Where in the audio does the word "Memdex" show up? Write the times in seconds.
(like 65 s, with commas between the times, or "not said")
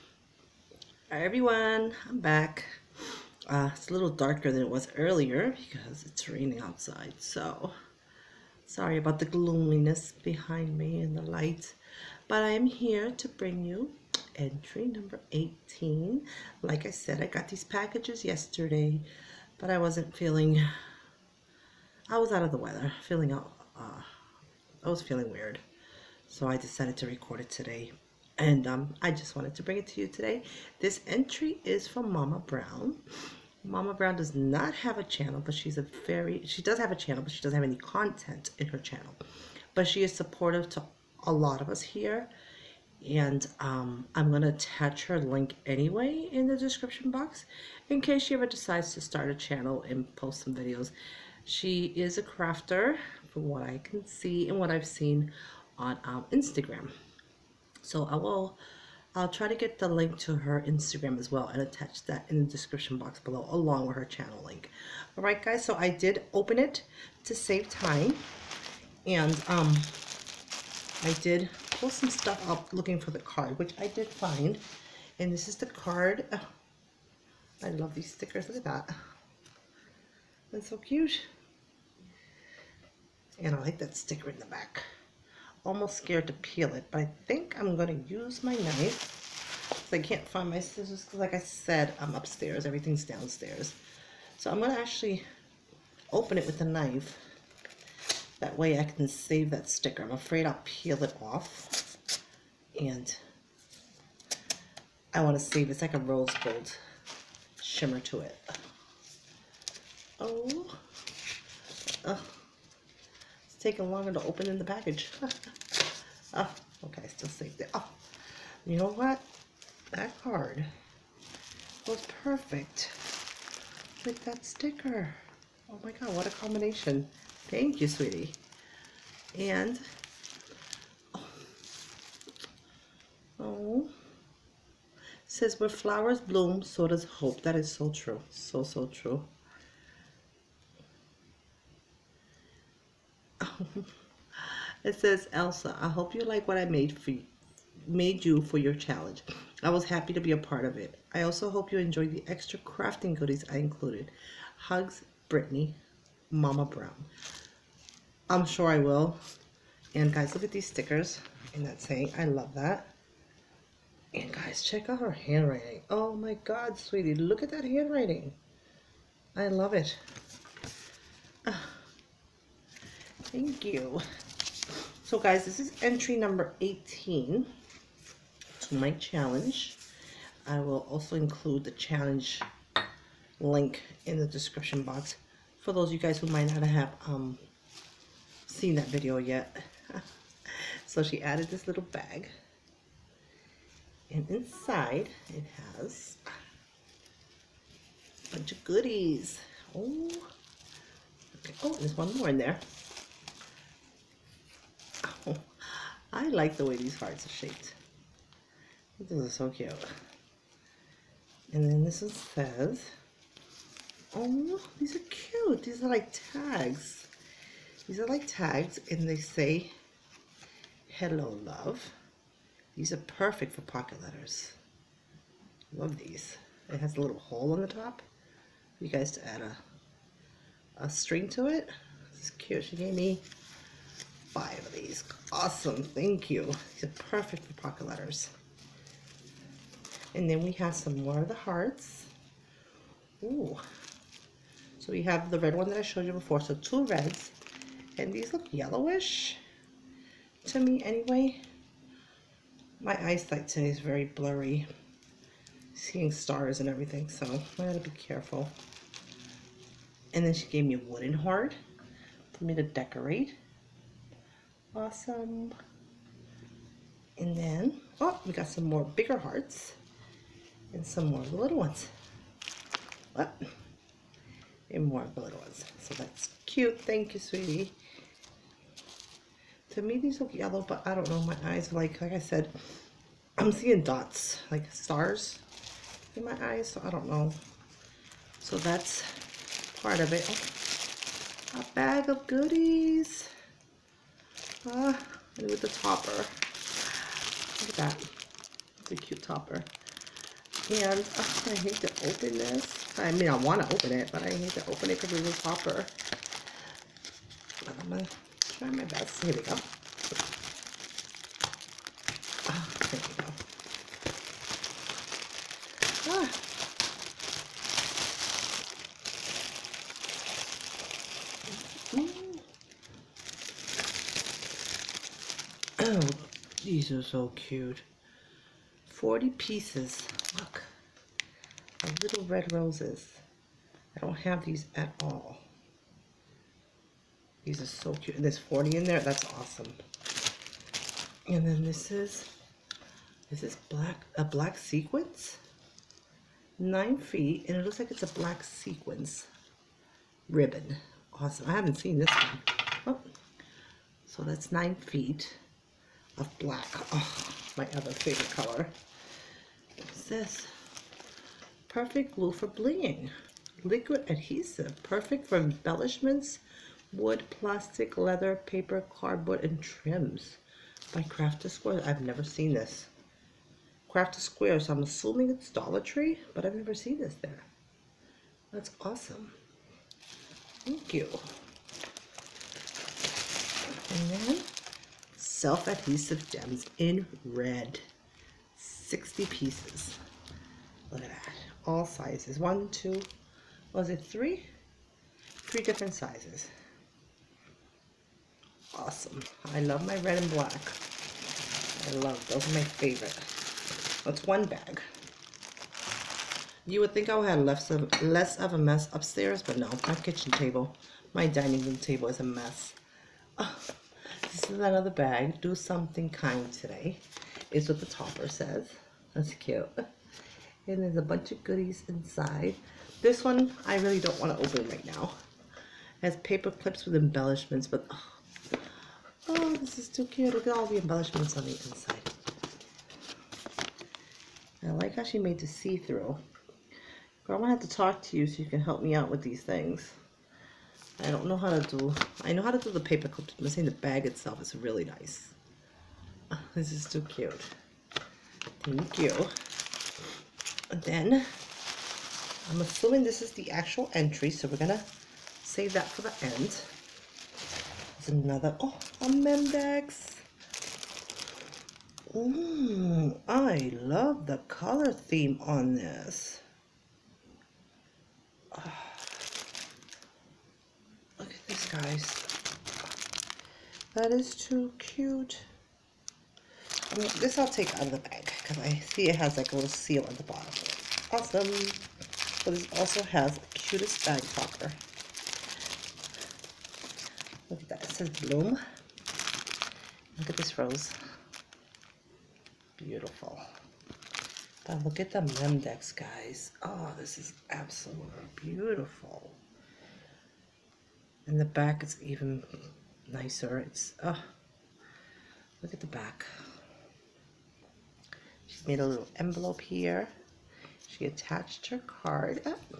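459 s, 495 s.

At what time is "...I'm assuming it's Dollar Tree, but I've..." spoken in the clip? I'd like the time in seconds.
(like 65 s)
374 s.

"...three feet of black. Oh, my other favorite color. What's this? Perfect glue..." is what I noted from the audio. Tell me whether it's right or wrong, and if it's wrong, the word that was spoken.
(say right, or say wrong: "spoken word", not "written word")
wrong: "nine", not "three".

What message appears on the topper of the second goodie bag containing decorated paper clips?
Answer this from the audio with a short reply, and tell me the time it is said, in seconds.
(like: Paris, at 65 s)
Do something kind today, at 415 s.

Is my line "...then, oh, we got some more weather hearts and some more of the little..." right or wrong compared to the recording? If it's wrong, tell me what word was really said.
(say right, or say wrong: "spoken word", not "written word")
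wrong: "bigger", not "weather".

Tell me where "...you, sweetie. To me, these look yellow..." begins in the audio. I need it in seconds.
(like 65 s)
277 s.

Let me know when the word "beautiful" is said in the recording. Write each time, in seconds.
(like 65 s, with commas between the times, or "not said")
492 s, 498 s.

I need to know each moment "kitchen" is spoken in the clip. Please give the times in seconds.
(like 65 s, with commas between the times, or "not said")
409 s.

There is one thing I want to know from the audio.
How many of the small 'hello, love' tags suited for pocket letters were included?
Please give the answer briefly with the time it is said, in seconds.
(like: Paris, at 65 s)
5, at 234 s.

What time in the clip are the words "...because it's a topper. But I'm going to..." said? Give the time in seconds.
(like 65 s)
305 s.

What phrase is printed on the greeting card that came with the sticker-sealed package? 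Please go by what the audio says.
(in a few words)
where flowers bloom, so does hope.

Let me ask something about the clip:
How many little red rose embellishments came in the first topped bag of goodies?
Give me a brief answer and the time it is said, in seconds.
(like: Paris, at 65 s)
40, at 328 s.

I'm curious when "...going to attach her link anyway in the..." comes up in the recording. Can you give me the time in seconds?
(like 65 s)
44 s.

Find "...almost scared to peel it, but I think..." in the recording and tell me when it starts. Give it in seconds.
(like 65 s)
85 s.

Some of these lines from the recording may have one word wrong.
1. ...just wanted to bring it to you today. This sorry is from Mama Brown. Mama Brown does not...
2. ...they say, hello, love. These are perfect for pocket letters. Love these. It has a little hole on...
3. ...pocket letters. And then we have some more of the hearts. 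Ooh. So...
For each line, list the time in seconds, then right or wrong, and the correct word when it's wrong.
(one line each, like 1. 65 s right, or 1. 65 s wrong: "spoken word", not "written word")
1. 29 s wrong: "entry", not "sorry"
2. 219 s right
3. 237 s right.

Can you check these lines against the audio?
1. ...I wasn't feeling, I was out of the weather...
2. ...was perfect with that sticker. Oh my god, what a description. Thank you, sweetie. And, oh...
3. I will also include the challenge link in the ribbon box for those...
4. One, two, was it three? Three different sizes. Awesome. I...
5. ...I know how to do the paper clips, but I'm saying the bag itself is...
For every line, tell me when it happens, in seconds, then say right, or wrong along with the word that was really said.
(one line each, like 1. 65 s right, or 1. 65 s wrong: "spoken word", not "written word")
1. 19 s right
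2. 121 s wrong: "combination", not "description"
3. 180 s wrong: "description", not "ribbon"
4. 392 s right
5. 442 s right.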